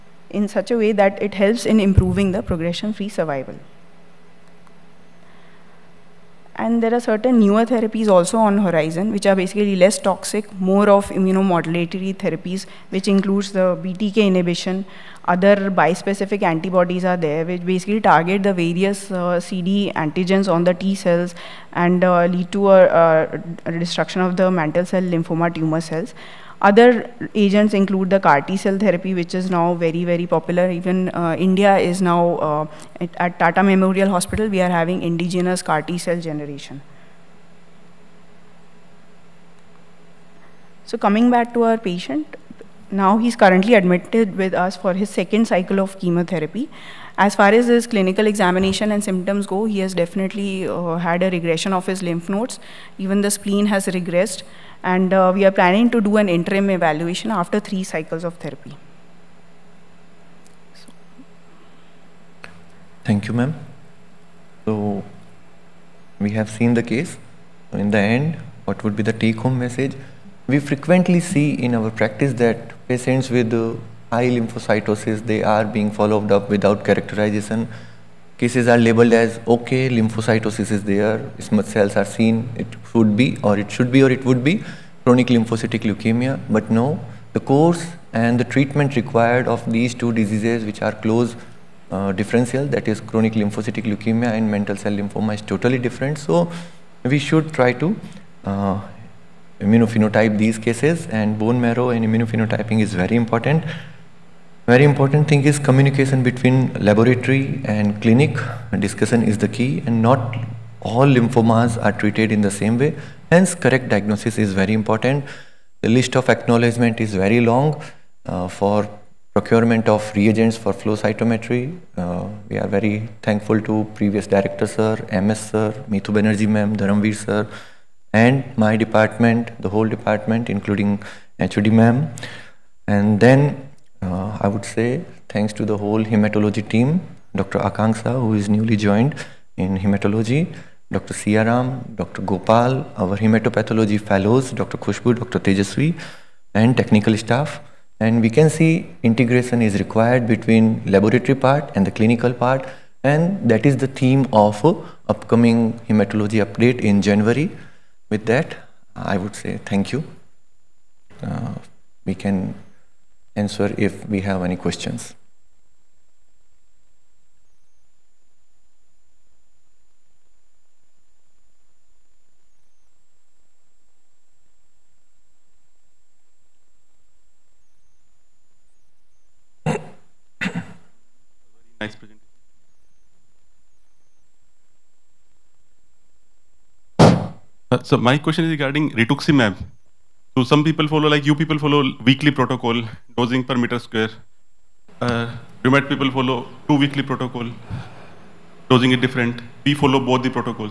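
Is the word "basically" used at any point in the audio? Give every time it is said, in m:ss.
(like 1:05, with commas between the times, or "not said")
0:09, 0:17.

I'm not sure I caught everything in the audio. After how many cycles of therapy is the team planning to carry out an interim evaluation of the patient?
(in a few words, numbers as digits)
3.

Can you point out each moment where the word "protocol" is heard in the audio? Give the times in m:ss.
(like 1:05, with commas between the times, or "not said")
3:12, 3:17.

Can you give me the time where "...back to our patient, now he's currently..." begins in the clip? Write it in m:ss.
0:41.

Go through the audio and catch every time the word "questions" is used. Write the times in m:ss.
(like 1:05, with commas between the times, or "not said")
2:44, 3:08.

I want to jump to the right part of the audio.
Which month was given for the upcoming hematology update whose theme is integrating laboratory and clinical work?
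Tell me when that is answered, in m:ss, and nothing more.
2:37.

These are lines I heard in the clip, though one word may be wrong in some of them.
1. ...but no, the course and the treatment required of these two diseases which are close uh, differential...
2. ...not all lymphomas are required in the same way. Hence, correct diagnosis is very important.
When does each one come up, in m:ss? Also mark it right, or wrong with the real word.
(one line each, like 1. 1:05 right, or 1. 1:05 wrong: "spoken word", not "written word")
1. 1:26 right
2. 1:50 wrong: "treated", not "required".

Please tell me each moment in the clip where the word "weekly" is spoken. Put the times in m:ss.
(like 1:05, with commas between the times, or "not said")
3:12, 3:16.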